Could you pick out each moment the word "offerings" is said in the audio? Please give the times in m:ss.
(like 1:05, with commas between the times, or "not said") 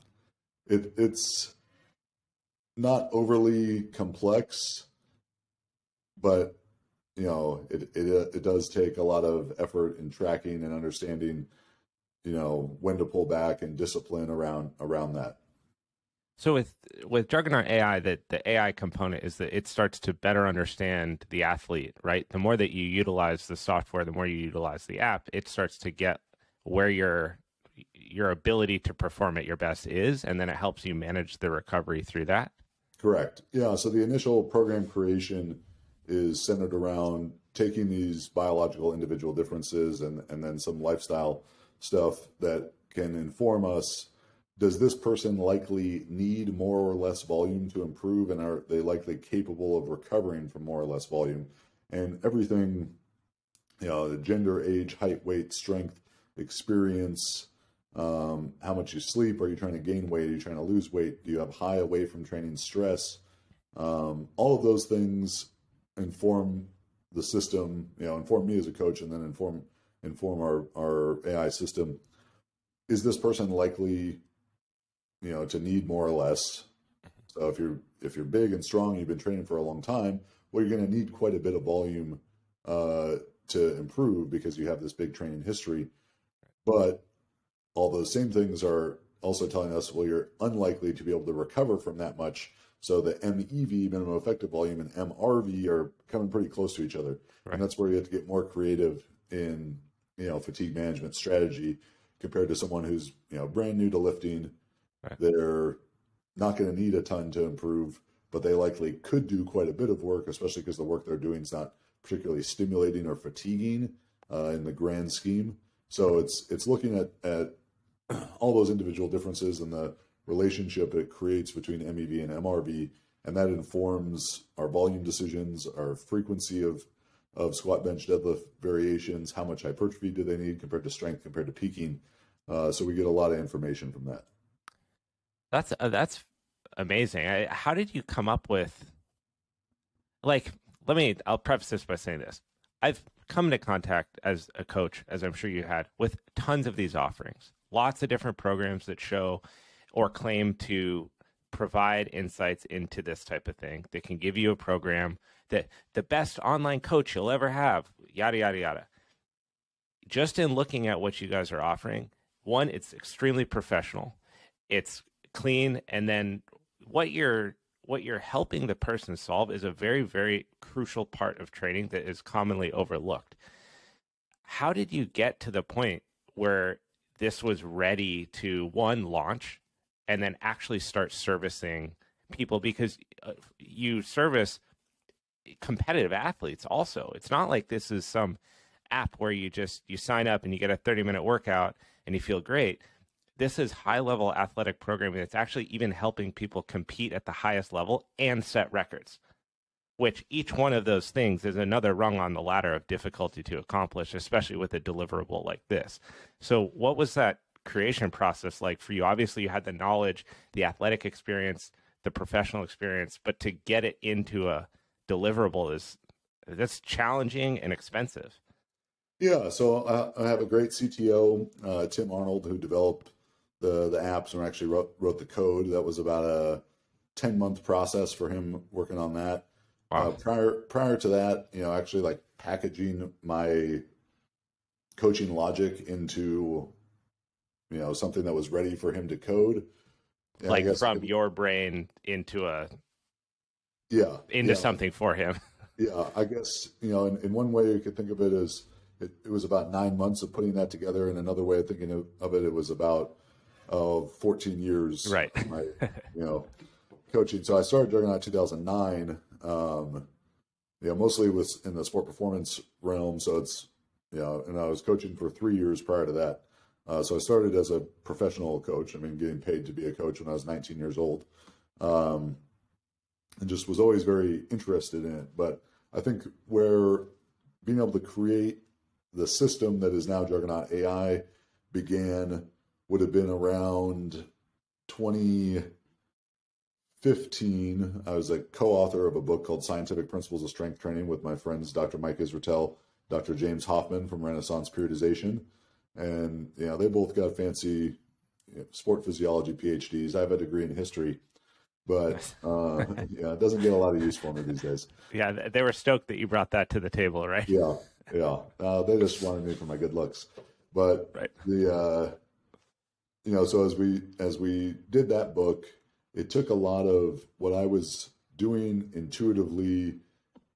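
2:26, 2:41.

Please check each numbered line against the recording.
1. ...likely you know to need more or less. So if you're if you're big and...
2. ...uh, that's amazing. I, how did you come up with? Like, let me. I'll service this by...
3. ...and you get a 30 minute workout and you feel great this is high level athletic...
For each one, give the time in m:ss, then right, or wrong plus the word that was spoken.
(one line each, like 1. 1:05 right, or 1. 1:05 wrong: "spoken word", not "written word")
1. 1:13 right
2. 2:15 wrong: "preface", not "service"
3. 3:10 right.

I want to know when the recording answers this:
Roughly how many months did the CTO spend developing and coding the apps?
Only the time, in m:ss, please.
3:47.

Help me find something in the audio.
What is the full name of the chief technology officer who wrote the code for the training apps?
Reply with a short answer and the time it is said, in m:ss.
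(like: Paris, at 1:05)
Tim Arnold, at 3:41.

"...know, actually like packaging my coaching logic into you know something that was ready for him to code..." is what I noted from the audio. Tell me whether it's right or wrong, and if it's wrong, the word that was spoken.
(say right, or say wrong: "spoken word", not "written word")
right.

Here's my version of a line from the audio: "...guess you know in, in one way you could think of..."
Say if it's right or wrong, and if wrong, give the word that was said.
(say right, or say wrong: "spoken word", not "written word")
right.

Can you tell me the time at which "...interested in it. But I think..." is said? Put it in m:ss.
4:34.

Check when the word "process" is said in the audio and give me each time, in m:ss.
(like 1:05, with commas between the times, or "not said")
3:28, 3:47.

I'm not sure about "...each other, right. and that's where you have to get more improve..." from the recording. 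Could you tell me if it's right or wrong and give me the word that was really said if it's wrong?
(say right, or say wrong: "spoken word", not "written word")
wrong: "creative", not "improve".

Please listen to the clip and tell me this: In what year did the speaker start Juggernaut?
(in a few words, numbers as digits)
2009.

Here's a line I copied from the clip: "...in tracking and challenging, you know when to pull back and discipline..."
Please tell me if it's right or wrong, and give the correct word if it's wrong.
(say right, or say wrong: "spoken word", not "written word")
wrong: "understanding", not "challenging".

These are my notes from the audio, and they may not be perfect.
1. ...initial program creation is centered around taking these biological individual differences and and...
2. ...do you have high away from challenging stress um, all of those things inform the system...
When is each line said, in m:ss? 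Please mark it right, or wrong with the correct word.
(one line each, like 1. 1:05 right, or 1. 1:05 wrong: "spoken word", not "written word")
1. 0:34 right
2. 1:01 wrong: "training", not "challenging".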